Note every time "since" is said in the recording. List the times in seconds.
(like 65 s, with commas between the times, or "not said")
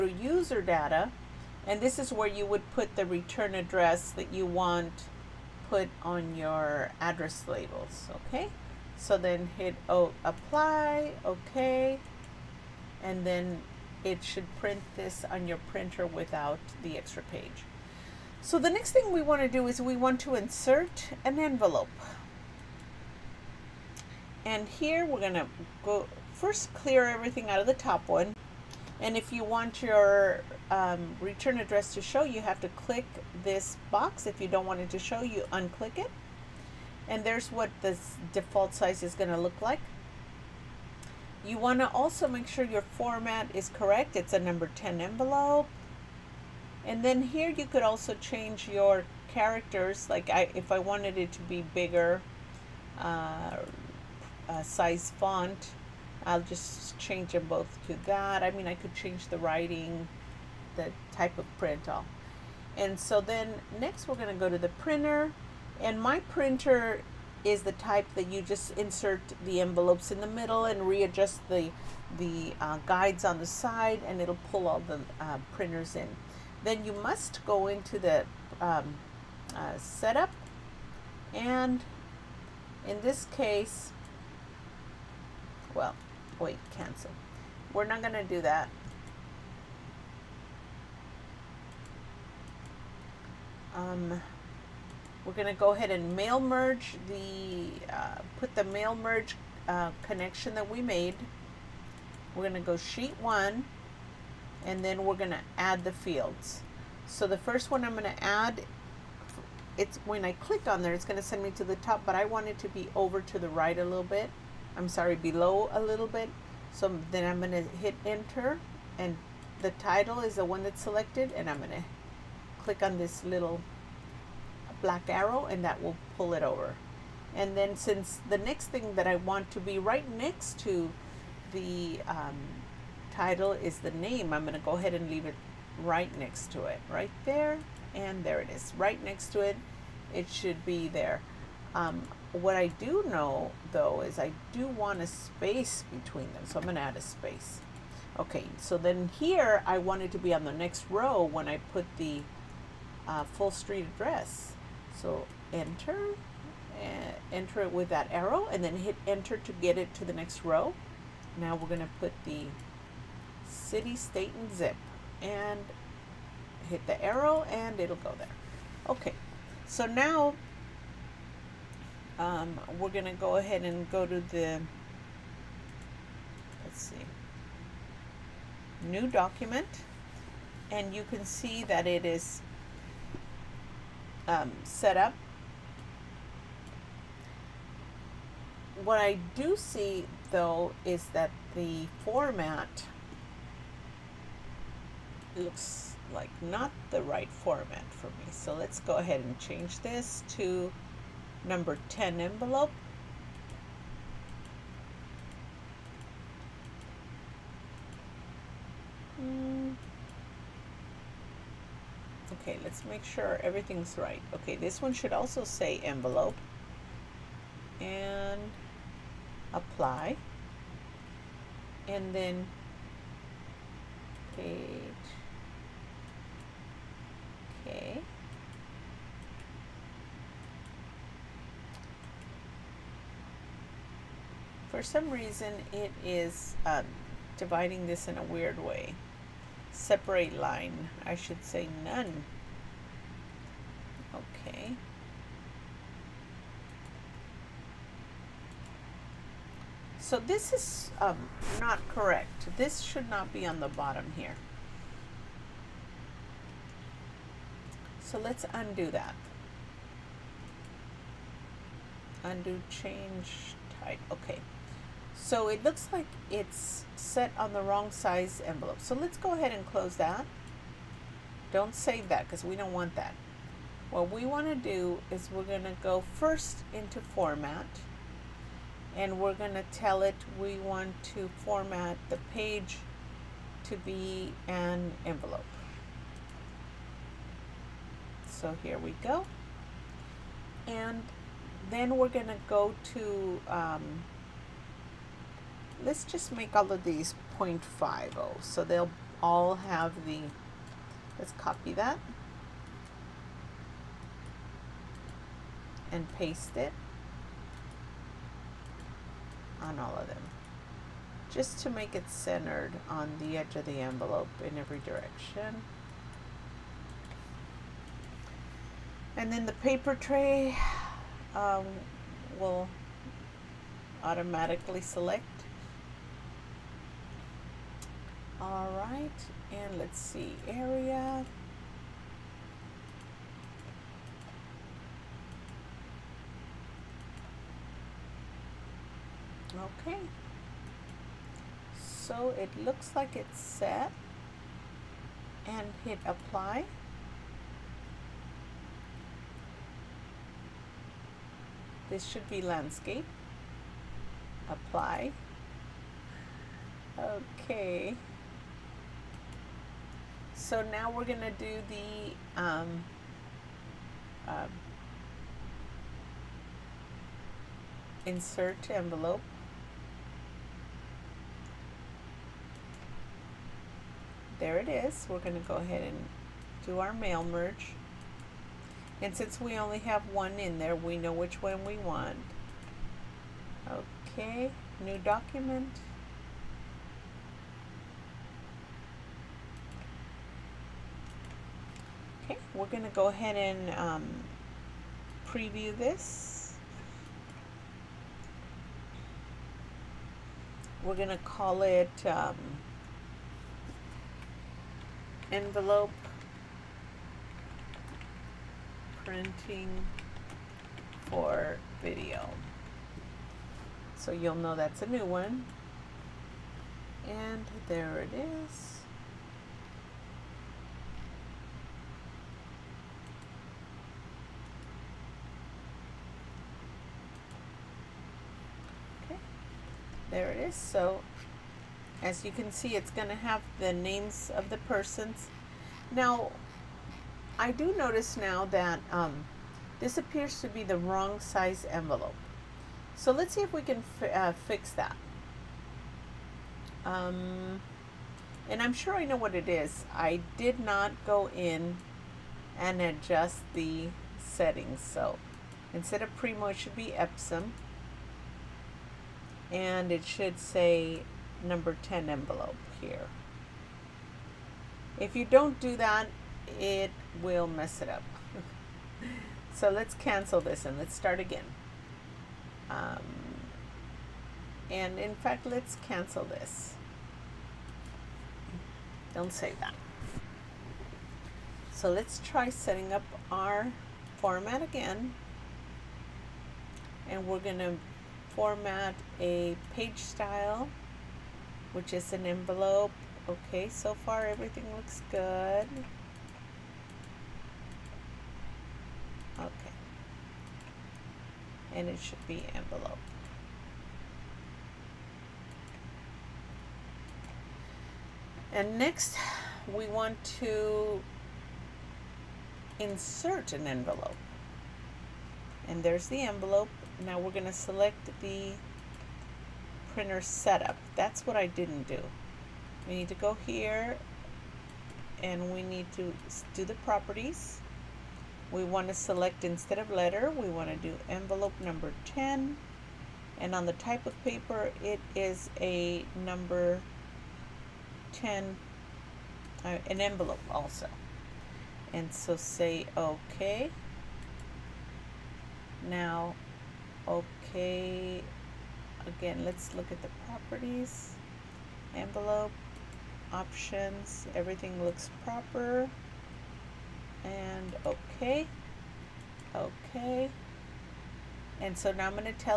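127 s, 379 s.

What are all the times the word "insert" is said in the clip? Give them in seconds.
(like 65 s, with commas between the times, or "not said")
20 s, 68 s, 368 s, 512 s.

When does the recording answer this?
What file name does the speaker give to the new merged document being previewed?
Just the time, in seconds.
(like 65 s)
405 s.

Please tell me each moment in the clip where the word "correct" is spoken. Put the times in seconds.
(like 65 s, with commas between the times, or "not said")
43 s, 251 s.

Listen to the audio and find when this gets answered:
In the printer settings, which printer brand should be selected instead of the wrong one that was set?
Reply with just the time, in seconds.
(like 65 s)
456 s.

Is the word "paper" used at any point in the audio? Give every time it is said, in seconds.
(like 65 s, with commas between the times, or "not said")
319 s, 534 s.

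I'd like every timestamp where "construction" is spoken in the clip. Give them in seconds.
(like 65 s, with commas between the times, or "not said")
not said.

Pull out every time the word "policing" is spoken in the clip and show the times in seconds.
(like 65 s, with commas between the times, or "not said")
not said.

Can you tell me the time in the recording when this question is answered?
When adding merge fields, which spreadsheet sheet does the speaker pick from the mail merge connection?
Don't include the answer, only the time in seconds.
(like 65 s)
102 s.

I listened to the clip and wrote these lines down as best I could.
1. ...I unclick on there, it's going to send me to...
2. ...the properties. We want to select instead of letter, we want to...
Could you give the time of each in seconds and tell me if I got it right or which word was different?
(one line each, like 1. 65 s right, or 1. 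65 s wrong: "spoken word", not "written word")
1. 110 s wrong: "click", not "unclick"
2. 526 s right.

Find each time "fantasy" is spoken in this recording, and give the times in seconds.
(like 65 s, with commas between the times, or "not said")
not said.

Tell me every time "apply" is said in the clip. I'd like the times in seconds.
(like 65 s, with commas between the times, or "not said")
10 s, 219 s, 346 s, 354 s.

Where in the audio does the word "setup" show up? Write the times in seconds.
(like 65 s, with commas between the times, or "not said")
79 s, 520 s.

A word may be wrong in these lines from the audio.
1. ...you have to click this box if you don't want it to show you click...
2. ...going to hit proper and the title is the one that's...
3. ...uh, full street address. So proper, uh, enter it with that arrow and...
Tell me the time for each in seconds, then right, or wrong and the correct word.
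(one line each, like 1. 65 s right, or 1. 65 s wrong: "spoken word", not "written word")
1. 32 s wrong: "unclick", not "click"
2. 117 s wrong: "enter", not "proper"
3. 153 s wrong: "enter", not "proper".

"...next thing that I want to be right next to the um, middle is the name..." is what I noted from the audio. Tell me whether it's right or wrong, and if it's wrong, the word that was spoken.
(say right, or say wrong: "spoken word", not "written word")
wrong: "title", not "middle".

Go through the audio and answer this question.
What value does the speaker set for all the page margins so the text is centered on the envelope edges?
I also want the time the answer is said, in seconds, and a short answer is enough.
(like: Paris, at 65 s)
0.50, at 297 s.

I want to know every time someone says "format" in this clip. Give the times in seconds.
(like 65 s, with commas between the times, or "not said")
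42 s, 192 s, 197 s, 277 s, 281 s, 484 s, 488 s.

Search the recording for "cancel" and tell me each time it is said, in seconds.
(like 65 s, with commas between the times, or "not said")
86 s, 469 s, 475 s.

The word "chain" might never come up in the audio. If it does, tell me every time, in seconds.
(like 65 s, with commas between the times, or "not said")
not said.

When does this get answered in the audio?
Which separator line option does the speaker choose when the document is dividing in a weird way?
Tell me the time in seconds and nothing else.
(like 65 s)
241 s.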